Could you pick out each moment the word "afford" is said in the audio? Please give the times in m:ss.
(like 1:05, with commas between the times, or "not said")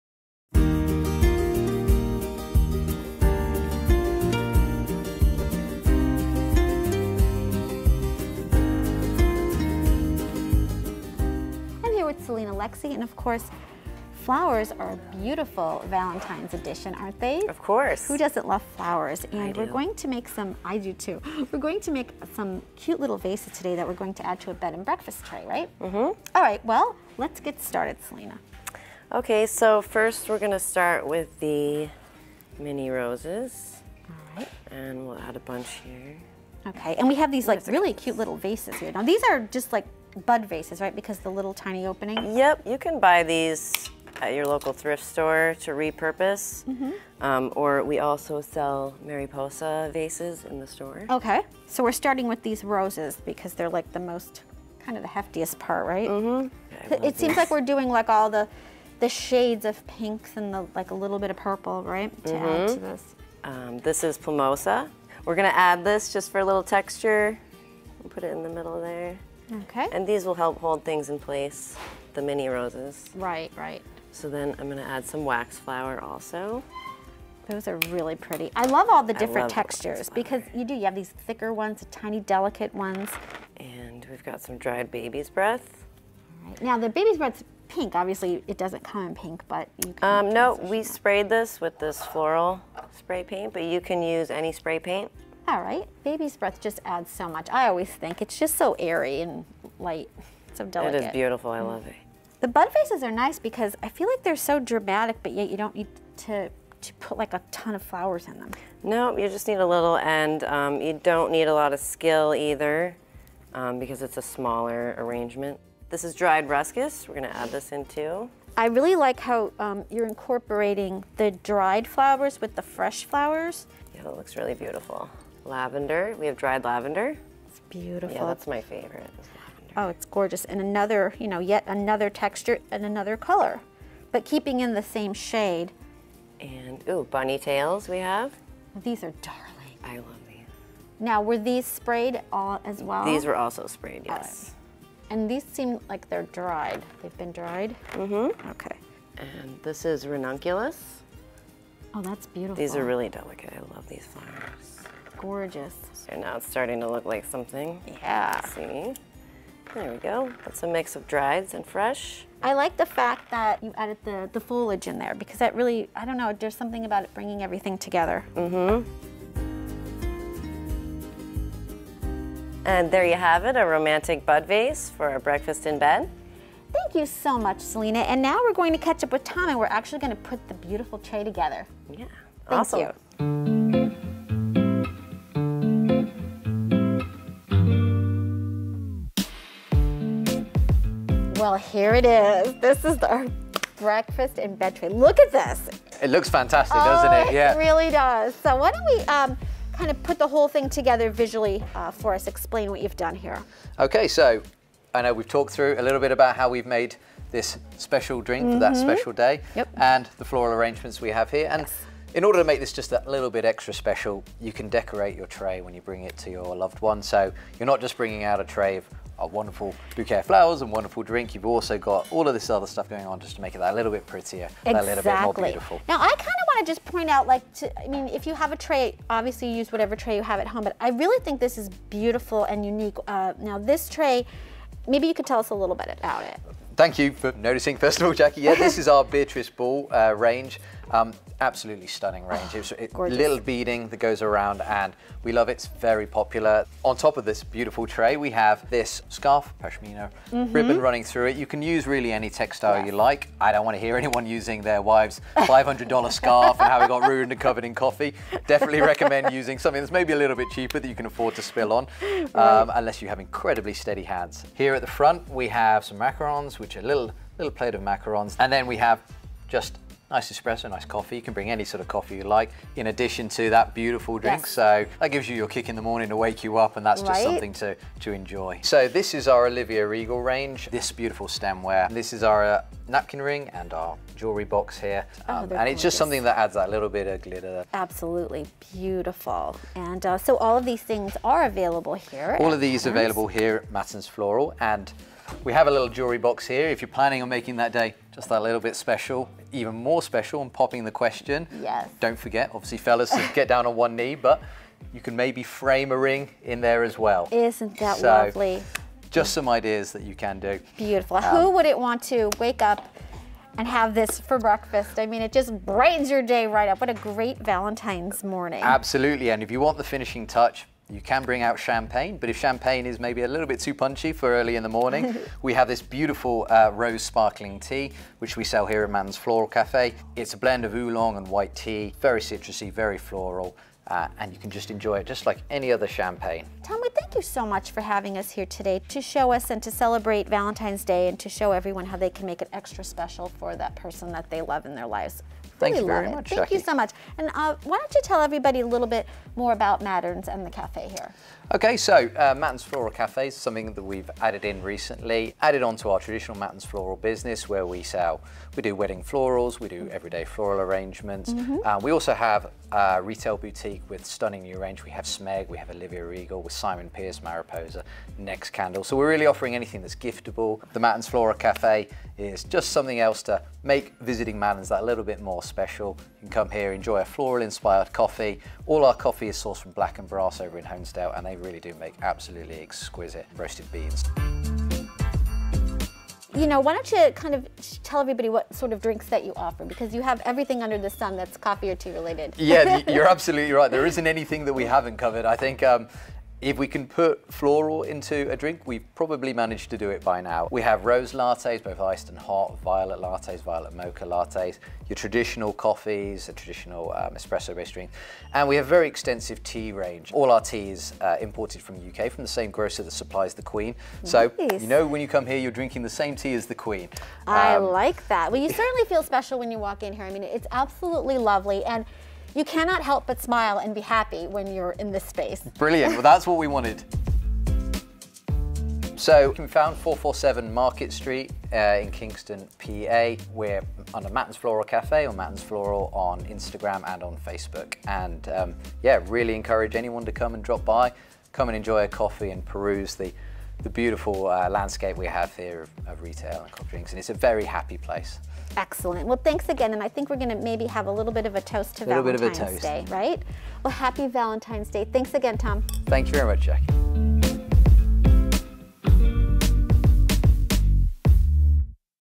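4:21.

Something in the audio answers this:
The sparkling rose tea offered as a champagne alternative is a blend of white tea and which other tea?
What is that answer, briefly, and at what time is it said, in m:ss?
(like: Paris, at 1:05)
Oolong, at 5:30.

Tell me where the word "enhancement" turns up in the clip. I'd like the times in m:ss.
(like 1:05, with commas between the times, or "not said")
not said.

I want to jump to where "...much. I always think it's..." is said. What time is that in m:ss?
1:37.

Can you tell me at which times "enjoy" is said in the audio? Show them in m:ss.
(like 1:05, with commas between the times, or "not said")
4:38, 5:34, 6:16, 7:21.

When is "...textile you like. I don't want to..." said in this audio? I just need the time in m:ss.
4:12.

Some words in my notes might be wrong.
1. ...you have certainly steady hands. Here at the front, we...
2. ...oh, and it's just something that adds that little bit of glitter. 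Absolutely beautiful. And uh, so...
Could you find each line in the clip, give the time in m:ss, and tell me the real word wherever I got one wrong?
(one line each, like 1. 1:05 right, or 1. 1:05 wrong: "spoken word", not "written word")
1. 4:23 wrong: "incredibly", not "certainly"
2. 4:45 right.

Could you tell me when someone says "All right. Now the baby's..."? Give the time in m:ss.
1:26.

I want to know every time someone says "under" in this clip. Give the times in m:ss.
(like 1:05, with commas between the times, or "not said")
6:30, 7:13.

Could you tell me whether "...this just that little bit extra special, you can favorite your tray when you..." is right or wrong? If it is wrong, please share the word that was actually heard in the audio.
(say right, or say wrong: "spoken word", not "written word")
wrong: "decorate", not "favorite".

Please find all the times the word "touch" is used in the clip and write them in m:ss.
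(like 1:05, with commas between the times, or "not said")
5:20.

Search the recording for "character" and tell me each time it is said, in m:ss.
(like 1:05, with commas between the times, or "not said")
not said.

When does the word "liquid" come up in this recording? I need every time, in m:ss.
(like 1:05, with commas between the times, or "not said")
not said.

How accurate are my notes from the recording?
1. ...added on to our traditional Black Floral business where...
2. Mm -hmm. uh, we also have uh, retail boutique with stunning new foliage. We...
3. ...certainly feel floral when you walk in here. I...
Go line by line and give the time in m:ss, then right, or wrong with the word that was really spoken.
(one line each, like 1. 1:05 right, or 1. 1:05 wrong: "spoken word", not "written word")
1. 5:55 wrong: "Matterns", not "Black"
2. 6:01 wrong: "range", not "foliage"
3. 6:58 wrong: "special", not "floral".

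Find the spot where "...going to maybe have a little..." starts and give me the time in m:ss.
7:30.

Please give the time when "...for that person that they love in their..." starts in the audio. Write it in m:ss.
5:43.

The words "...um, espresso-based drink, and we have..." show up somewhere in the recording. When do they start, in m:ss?
6:46.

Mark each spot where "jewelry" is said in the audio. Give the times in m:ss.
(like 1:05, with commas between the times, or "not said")
4:44, 4:55.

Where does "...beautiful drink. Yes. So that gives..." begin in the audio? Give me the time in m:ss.
4:33.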